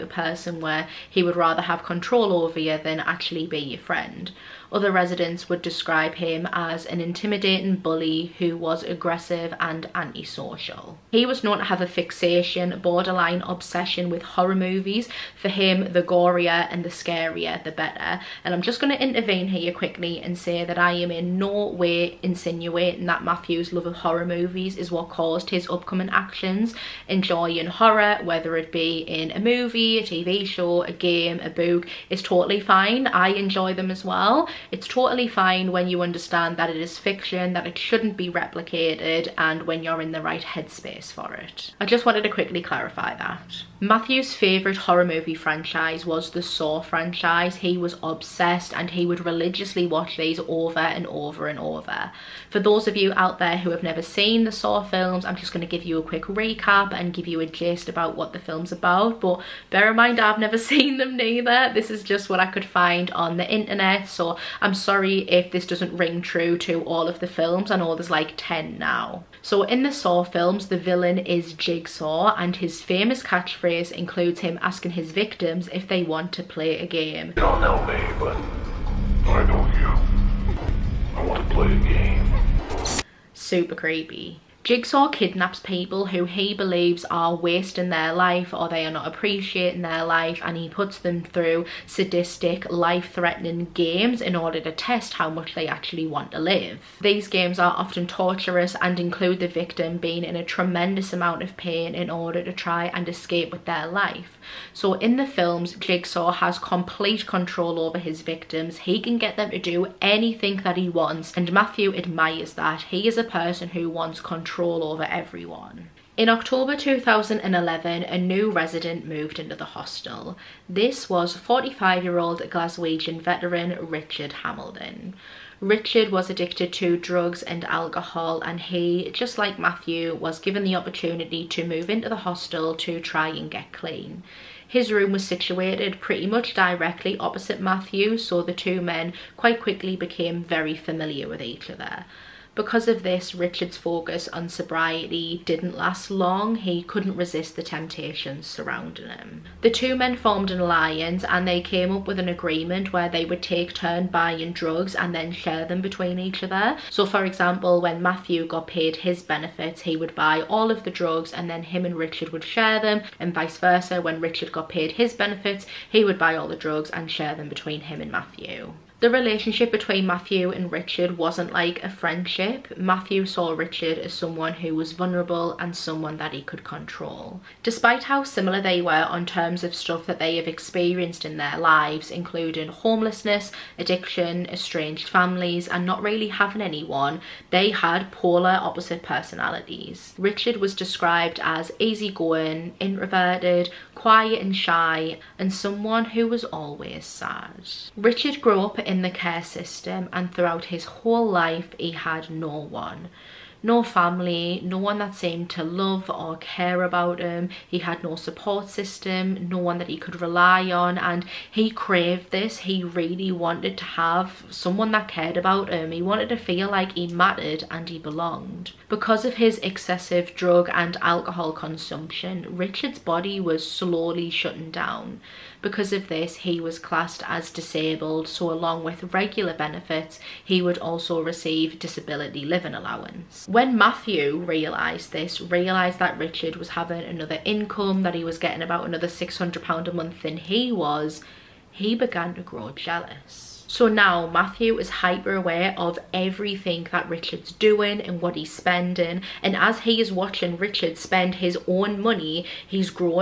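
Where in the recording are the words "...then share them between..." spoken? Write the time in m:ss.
2:35.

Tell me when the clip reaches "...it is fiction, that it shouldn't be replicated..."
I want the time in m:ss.
0:36.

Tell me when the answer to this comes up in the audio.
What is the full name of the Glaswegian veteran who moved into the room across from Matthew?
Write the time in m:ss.
2:03.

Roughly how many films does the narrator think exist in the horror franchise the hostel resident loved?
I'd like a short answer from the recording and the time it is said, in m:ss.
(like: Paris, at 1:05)
10, at 1:08.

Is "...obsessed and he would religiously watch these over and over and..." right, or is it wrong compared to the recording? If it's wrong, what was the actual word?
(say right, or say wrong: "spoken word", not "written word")
right.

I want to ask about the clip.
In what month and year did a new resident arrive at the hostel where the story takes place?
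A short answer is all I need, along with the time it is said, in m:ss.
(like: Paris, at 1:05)
October 2011, at 1:56.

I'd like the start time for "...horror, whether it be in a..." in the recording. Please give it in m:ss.
0:27.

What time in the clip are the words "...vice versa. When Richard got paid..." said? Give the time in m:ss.
2:43.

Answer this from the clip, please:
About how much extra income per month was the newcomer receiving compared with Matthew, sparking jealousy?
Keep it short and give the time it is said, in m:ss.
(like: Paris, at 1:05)
£600, at 3:59.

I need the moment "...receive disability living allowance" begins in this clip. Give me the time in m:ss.
3:51.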